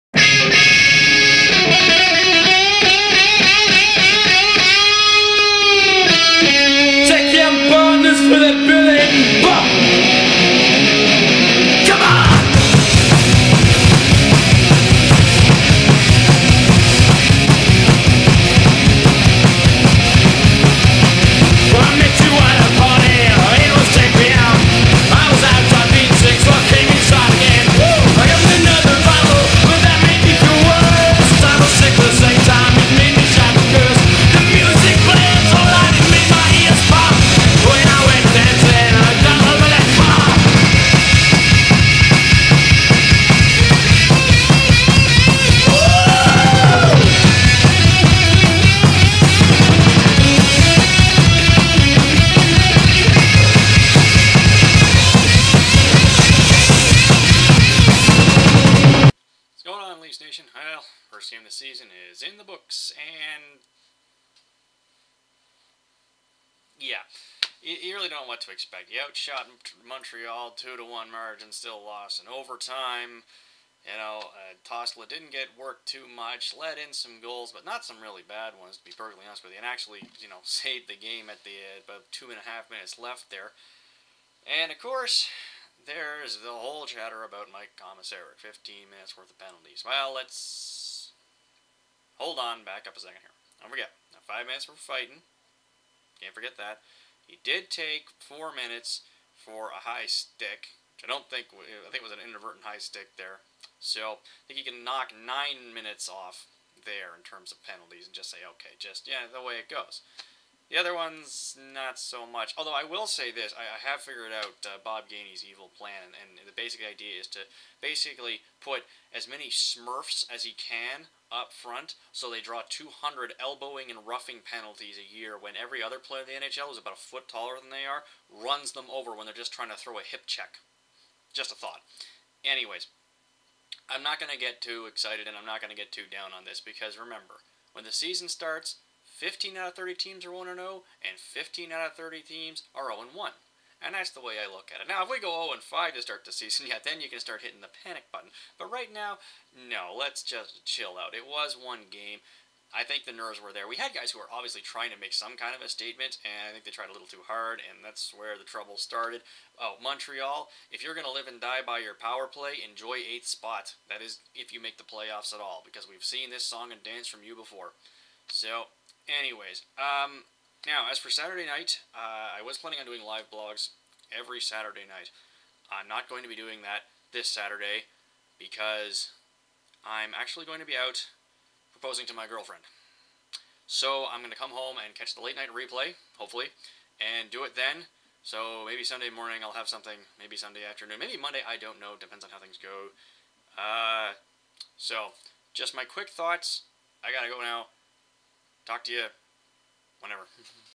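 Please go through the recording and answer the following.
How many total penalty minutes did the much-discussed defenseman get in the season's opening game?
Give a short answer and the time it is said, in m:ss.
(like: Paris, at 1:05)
15, at 1:28.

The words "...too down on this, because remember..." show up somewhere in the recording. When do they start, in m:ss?
2:15.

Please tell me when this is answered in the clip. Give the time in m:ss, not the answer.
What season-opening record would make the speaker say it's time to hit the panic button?
2:25.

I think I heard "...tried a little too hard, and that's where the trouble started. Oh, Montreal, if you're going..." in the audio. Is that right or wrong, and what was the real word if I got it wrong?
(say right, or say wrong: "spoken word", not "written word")
right.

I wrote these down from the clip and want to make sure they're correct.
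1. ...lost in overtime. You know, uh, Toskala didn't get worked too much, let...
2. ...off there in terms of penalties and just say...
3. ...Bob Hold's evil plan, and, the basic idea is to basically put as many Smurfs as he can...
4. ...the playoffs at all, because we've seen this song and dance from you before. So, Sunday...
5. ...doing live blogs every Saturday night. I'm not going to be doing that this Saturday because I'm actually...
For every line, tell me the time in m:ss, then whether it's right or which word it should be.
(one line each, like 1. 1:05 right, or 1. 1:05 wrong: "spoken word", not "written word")
1. 1:11 right
2. 1:46 right
3. 1:54 wrong: "Gainey", not "Hold"
4. 2:44 wrong: "Anyways", not "Sunday"
5. 2:52 right.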